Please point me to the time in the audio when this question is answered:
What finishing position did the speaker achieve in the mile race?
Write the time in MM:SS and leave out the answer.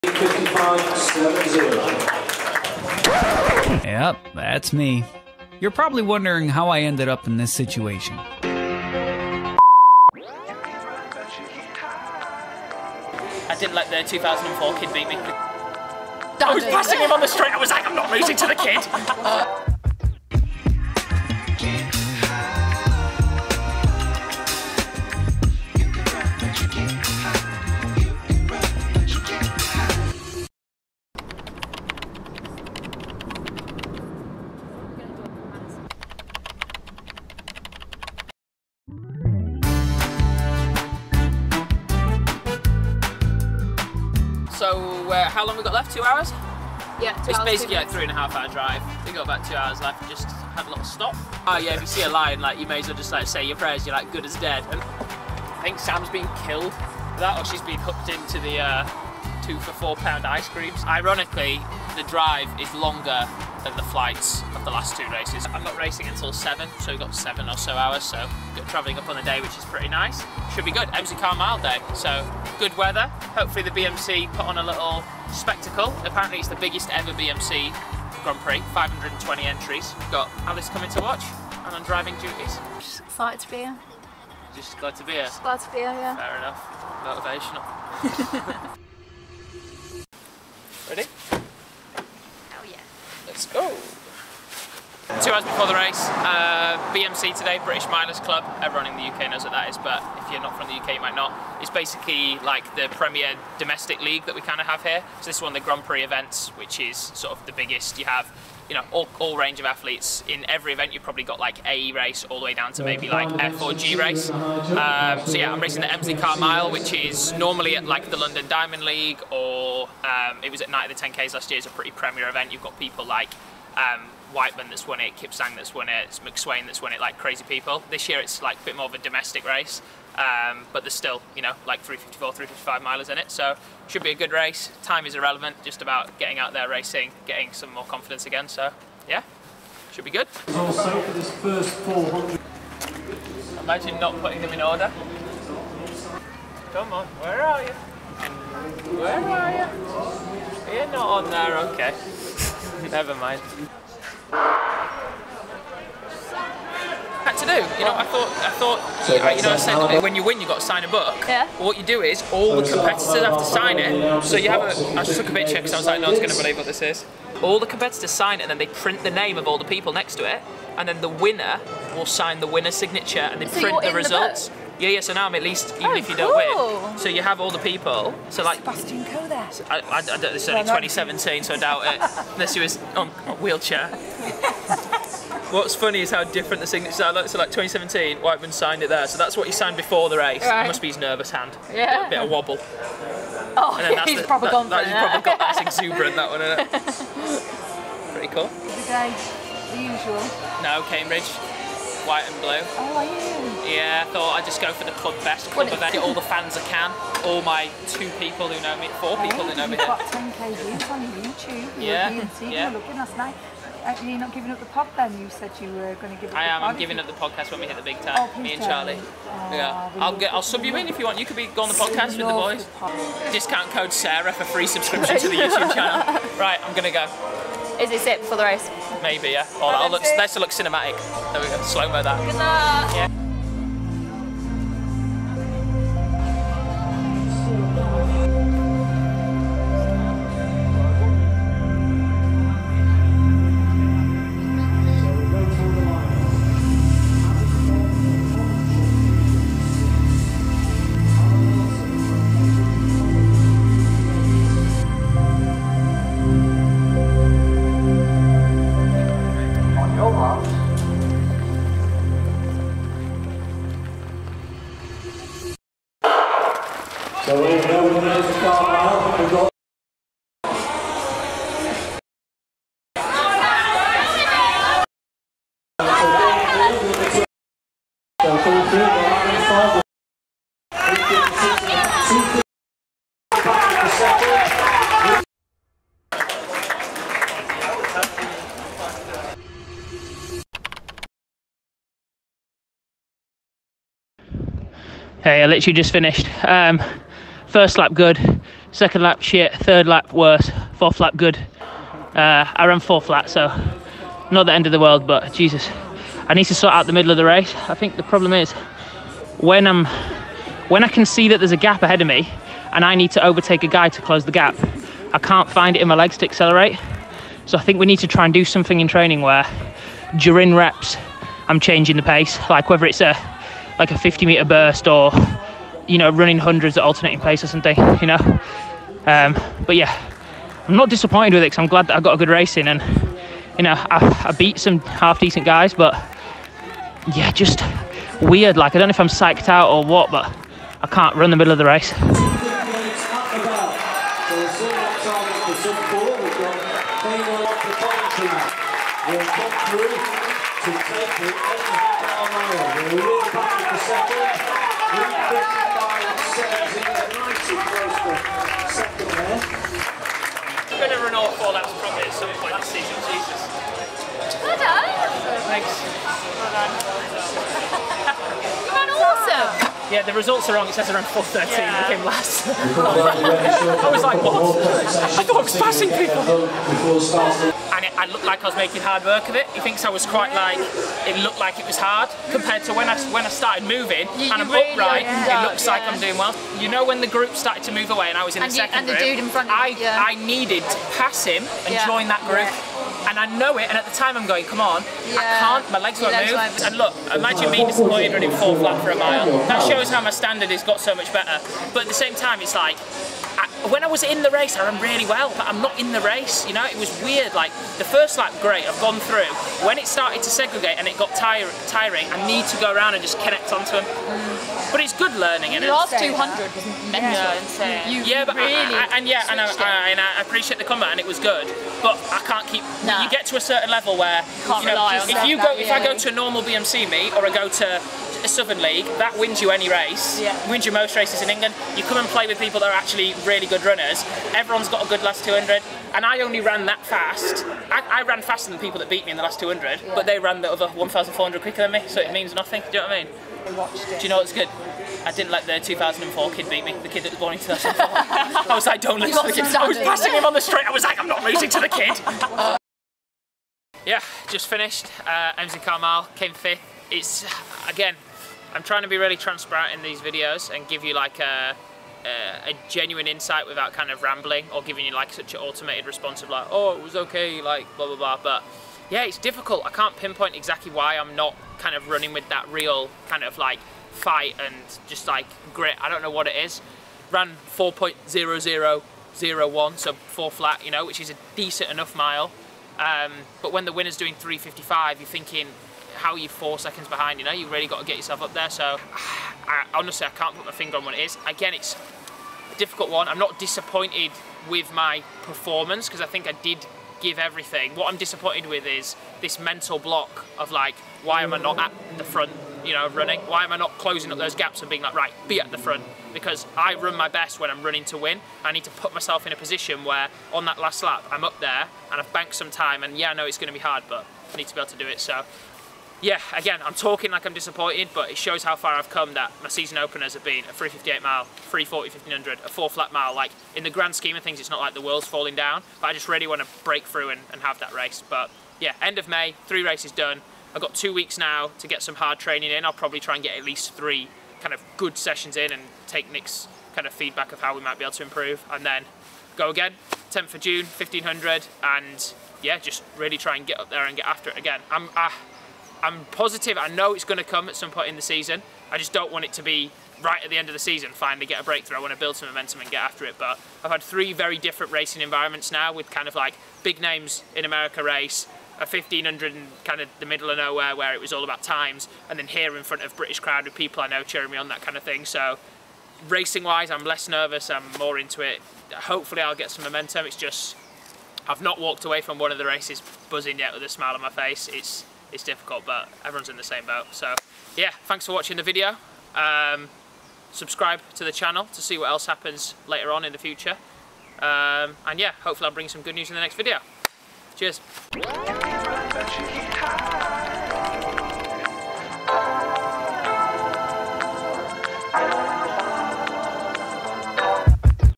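07:36.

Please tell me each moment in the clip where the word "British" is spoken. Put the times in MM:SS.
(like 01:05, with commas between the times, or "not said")
01:37, 09:22.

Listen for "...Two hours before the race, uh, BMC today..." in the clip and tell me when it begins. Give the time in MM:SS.
01:35.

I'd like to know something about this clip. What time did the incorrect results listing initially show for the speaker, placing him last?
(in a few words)
4.13.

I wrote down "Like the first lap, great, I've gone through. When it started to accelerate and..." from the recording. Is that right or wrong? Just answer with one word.
wrong.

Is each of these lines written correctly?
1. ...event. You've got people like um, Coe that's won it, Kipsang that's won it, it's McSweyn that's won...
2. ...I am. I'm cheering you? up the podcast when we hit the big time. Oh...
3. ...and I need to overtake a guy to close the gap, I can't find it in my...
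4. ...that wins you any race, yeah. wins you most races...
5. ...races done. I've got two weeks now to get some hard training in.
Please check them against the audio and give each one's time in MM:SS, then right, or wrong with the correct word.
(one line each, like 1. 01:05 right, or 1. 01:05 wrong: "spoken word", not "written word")
1. 02:02 wrong: "Wightman", not "Coe"
2. 03:36 wrong: "giving", not "cheering"
3. 05:12 right
4. 07:08 right
5. 08:49 right.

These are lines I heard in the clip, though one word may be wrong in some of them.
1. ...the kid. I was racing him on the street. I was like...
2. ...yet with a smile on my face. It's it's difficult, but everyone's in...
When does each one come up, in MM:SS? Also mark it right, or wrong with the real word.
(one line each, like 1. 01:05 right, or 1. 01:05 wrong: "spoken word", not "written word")
1. 07:29 wrong: "passing", not "racing"
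2. 09:33 right.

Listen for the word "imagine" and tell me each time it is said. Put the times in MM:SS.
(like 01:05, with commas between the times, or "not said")
02:23, 06:37.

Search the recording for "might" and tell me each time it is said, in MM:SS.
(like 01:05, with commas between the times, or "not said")
01:41, 08:57.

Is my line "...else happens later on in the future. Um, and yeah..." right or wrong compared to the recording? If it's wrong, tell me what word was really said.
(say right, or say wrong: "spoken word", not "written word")
right.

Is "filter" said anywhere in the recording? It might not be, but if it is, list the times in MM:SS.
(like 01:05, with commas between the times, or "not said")
not said.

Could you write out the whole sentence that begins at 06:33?
And at the time, I'm going, come on, yeah.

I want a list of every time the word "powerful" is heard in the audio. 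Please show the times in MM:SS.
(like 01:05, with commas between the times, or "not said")
not said.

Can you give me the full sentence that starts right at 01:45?
So this one, the Grand Prix events, which is sort of the biggest.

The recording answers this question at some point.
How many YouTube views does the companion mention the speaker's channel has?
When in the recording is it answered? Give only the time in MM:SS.
03:29.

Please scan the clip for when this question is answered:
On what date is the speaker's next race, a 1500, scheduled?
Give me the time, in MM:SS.
09:00.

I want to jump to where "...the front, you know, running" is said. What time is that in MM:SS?
08:21.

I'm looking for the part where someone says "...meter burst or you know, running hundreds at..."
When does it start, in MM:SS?
05:24.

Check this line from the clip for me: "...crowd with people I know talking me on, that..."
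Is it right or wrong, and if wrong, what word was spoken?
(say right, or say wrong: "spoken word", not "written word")
wrong: "cheering", not "talking".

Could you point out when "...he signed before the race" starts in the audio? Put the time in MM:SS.
03:09.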